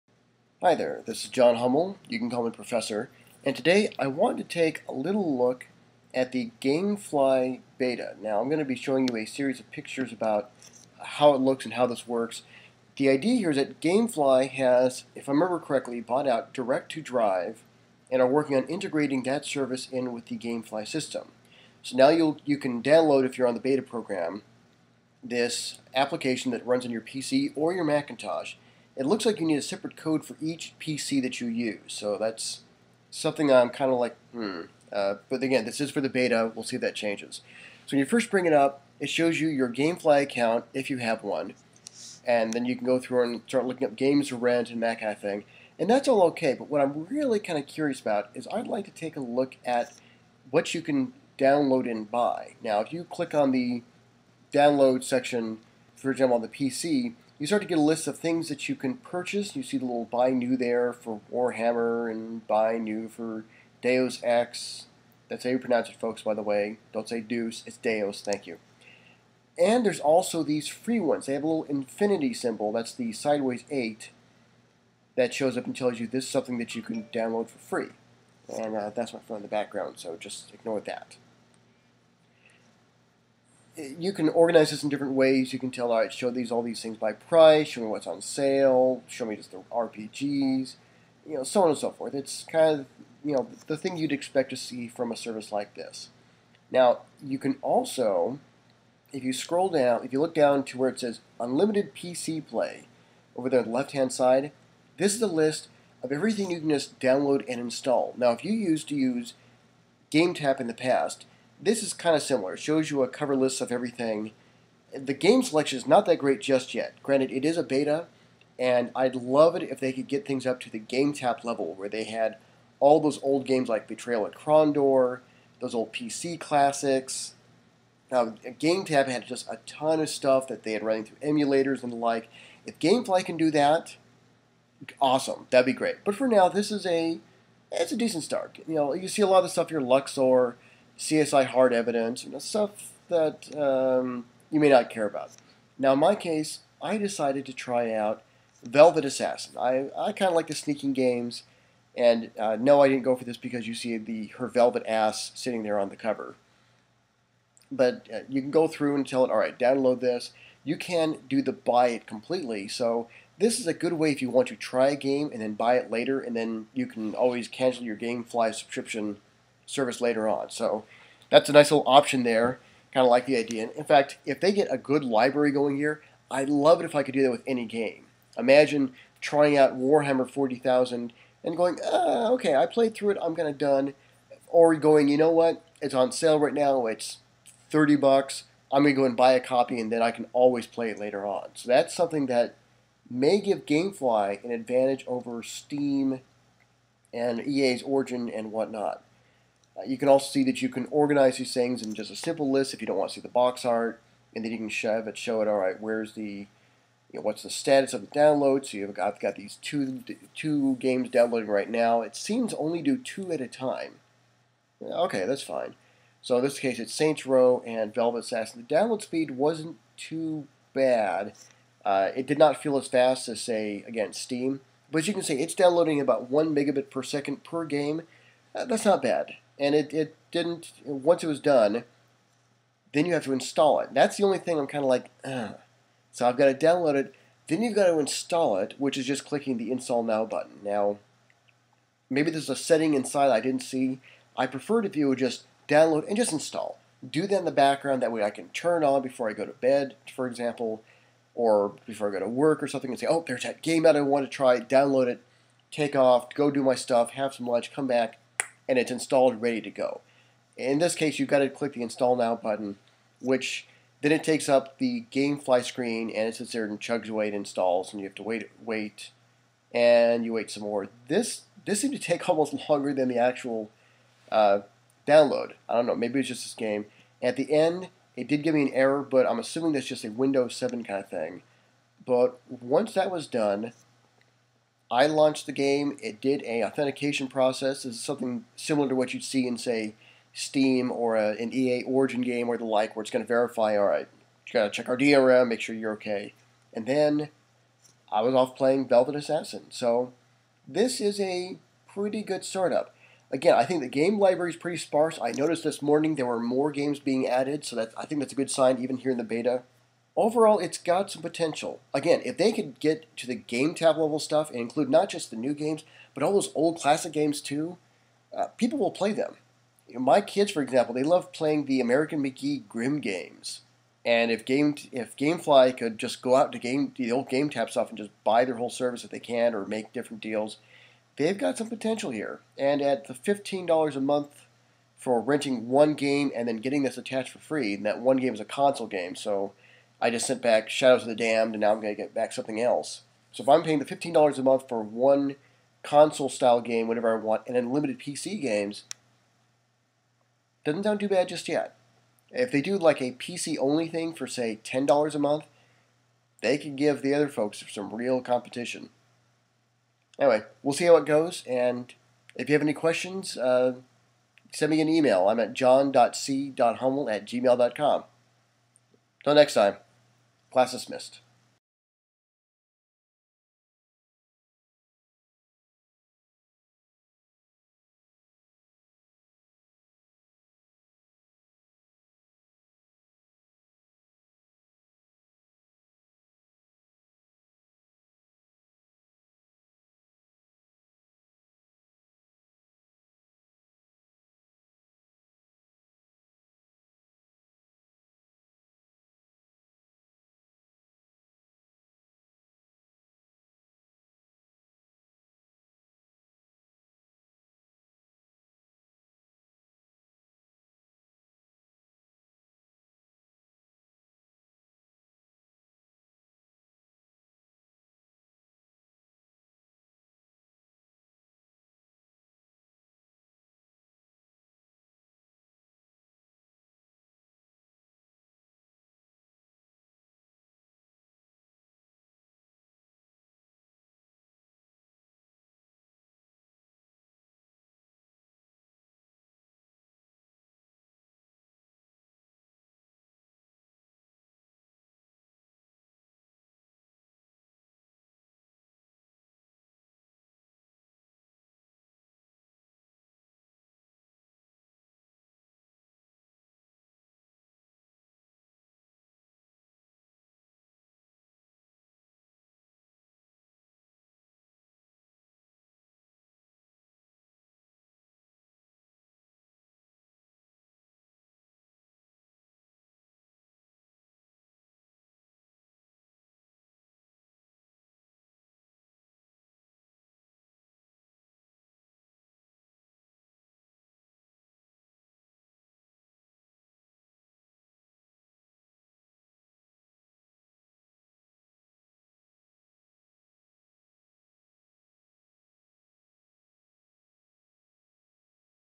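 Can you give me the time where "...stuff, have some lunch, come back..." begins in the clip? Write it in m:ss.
4:16.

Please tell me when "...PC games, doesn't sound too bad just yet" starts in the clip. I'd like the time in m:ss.
5:47.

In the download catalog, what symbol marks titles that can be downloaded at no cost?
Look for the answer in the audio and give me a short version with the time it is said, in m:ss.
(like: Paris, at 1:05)
infinity symbol, at 1:11.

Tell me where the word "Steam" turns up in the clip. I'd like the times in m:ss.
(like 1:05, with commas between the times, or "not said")
3:15, 3:44, 4:50.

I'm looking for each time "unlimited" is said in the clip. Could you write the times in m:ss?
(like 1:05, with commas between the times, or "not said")
1:41, 5:47.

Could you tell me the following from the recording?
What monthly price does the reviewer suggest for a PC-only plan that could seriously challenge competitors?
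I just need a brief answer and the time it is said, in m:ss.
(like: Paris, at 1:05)
$10 a month, at 5:54.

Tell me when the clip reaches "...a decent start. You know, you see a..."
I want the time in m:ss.
2:17.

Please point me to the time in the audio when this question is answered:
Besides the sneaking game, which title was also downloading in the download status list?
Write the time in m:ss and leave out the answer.
3:36.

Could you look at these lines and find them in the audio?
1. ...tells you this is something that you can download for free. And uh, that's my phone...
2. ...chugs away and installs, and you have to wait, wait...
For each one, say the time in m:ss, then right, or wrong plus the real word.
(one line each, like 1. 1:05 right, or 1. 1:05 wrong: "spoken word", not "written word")
1. 1:15 right
2. 4:26 right.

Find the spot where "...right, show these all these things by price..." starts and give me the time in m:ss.
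1:25.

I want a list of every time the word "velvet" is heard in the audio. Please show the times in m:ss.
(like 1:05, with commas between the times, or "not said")
2:28, 2:34, 3:37, 4:58.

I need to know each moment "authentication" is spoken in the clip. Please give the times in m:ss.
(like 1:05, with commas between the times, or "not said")
4:46.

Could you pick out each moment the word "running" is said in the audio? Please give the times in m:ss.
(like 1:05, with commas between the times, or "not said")
2:10.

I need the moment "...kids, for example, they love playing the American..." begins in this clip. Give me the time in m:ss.
5:20.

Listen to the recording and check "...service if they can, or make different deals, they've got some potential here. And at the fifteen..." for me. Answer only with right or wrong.
right.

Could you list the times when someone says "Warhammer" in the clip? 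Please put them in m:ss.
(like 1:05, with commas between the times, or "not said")
1:01, 2:59.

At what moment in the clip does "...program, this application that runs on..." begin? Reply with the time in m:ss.
0:23.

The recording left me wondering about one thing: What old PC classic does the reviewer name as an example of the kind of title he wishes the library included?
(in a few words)
Betrayal at Krondor.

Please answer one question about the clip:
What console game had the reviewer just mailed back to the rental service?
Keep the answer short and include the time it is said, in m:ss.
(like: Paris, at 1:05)
Shadows of the Damned, at 5:40.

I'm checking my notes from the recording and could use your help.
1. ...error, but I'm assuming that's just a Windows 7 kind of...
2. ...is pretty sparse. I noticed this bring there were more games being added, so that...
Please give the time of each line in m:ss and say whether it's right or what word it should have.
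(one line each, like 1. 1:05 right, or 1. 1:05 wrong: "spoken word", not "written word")
1. 4:38 right
2. 5:04 wrong: "morning", not "bring".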